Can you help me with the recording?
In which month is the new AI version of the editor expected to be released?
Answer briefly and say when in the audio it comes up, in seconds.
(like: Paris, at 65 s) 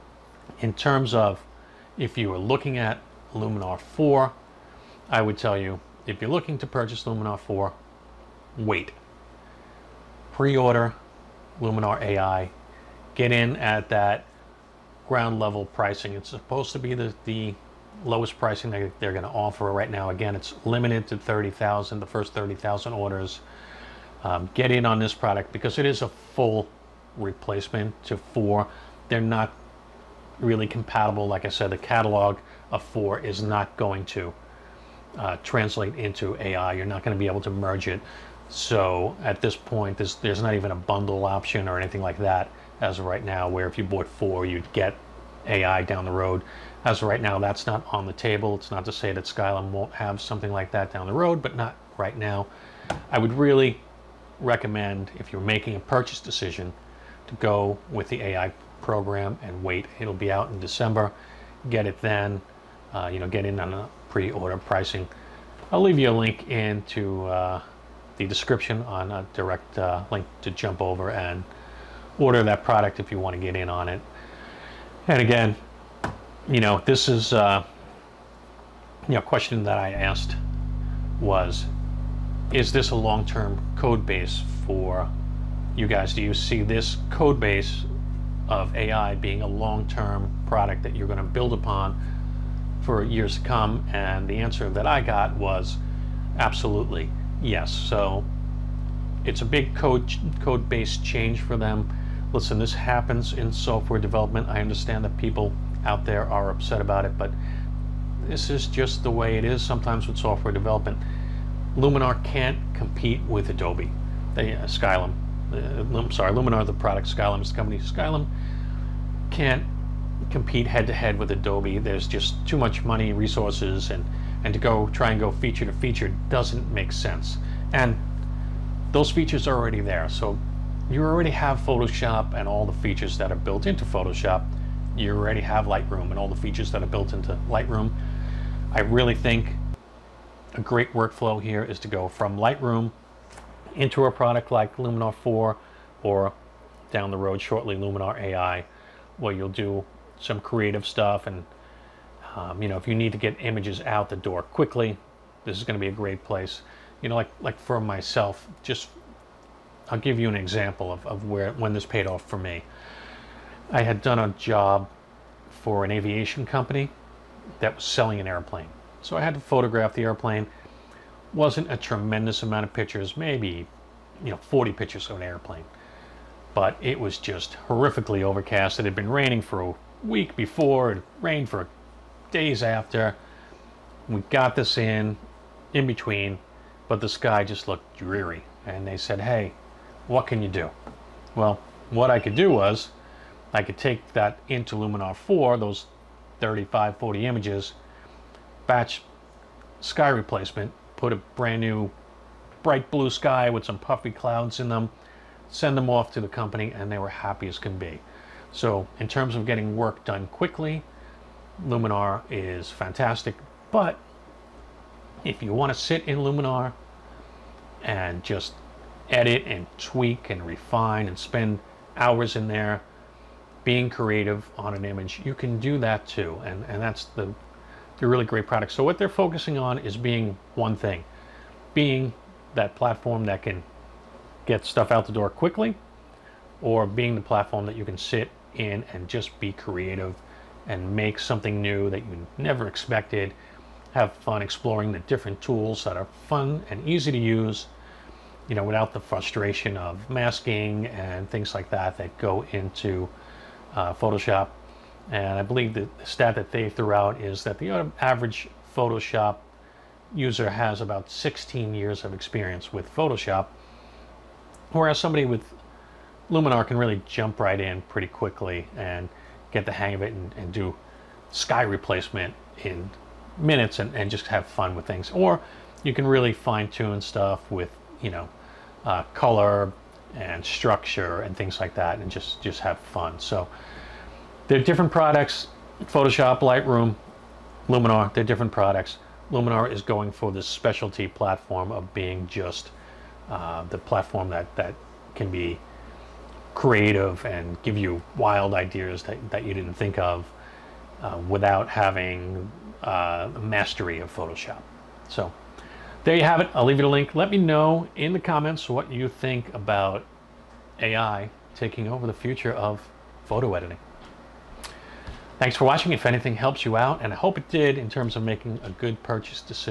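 December, at 60 s.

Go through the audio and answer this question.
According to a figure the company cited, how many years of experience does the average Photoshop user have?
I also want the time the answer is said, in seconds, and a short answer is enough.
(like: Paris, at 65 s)
16, at 261 s.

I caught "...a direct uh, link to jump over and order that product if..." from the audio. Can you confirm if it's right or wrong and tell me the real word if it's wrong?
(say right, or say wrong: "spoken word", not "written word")
right.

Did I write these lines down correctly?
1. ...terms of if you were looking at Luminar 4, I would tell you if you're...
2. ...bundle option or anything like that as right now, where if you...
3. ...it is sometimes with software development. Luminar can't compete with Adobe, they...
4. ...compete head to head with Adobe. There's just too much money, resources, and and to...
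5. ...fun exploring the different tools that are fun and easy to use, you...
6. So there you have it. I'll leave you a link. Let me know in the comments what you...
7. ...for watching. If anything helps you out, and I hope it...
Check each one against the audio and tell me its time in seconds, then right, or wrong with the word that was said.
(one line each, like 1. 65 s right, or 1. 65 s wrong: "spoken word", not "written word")
1. 0 s right
2. 40 s right
3. 109 s right
4. 120 s right
5. 244 s right
6. 305 s right
7. 315 s right.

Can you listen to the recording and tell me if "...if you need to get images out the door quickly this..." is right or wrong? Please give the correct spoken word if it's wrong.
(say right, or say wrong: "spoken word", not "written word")
right.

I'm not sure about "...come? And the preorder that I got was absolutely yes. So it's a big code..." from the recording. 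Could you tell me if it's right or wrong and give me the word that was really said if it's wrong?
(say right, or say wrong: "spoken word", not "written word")
wrong: "answer", not "preorder".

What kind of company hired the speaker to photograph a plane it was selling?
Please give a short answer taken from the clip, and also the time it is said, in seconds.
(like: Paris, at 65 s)
Aviation company, at 165 s.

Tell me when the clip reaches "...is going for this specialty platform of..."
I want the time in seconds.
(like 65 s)
289 s.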